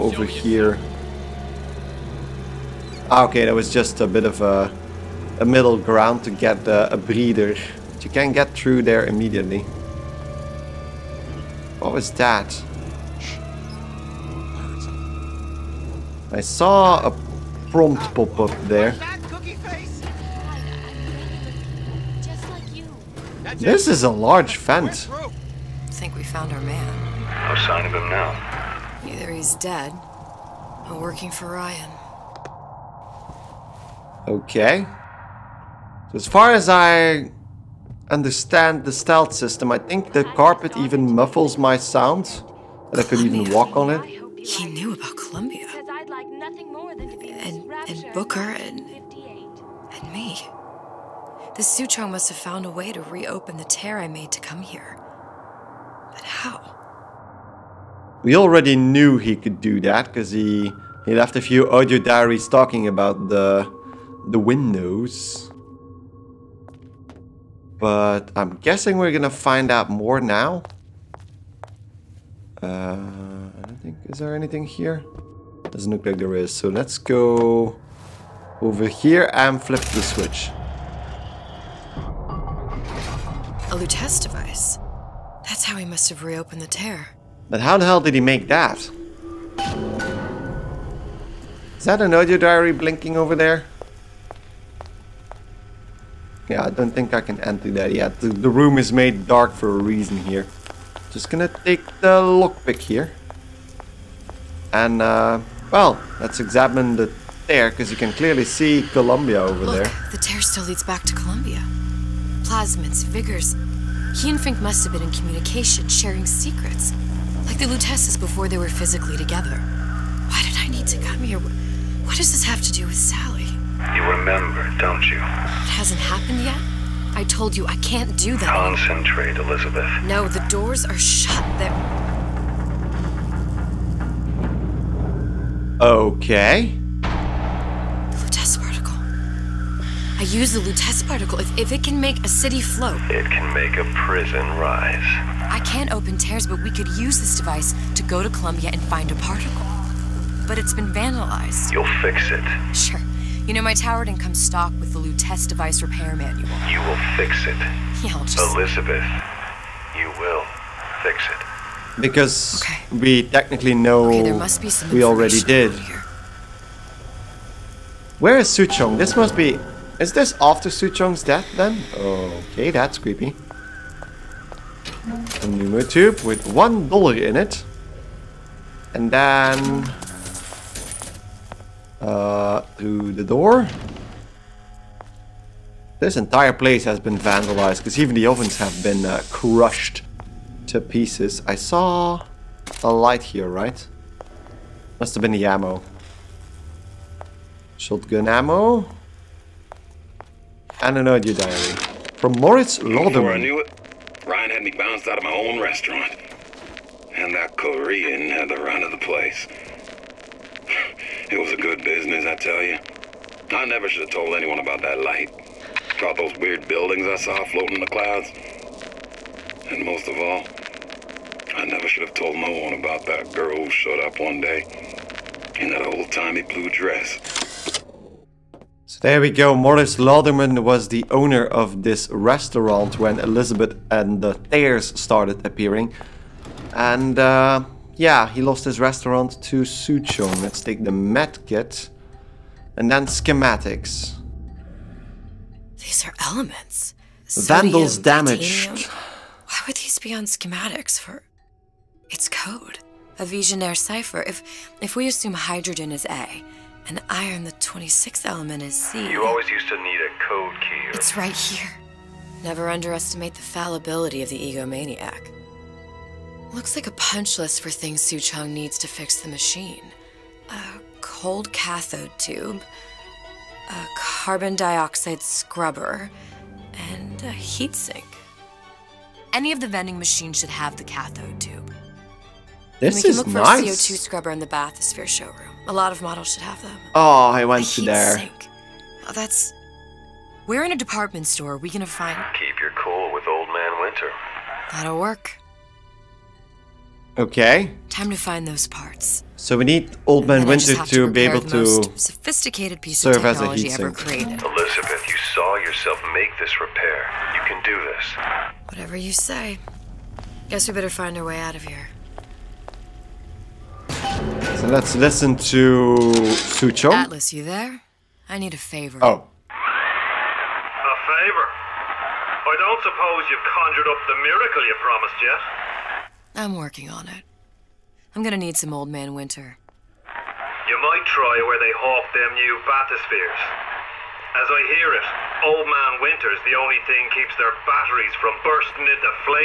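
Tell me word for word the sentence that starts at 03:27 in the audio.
And that Korean had the run of the place.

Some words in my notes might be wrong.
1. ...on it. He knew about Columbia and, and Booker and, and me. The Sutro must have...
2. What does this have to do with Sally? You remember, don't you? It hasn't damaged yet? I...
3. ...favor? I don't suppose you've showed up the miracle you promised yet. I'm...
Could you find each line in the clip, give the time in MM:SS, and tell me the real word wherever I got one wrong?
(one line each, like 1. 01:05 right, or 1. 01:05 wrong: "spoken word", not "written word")
1. 00:43 right
2. 02:01 wrong: "happened", not "damaged"
3. 05:21 wrong: "conjured", not "showed".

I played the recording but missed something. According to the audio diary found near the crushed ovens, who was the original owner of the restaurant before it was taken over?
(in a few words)
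Moritz Lauderman.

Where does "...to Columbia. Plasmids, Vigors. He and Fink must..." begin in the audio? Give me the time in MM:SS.
01:51.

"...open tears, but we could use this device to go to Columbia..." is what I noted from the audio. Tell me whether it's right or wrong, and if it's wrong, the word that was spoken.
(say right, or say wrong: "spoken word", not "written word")
right.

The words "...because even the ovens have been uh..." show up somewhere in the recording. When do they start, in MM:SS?
03:07.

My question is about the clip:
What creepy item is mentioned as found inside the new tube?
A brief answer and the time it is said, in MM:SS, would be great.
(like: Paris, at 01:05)
one dollar, at 02:56.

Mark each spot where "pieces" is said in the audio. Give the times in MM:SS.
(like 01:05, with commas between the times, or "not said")
03:10, 05:02.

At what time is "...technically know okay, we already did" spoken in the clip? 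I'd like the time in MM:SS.
02:43.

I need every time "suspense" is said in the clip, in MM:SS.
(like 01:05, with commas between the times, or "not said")
not said.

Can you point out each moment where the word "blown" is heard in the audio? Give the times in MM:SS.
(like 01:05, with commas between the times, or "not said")
not said.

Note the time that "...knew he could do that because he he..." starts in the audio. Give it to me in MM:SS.
00:58.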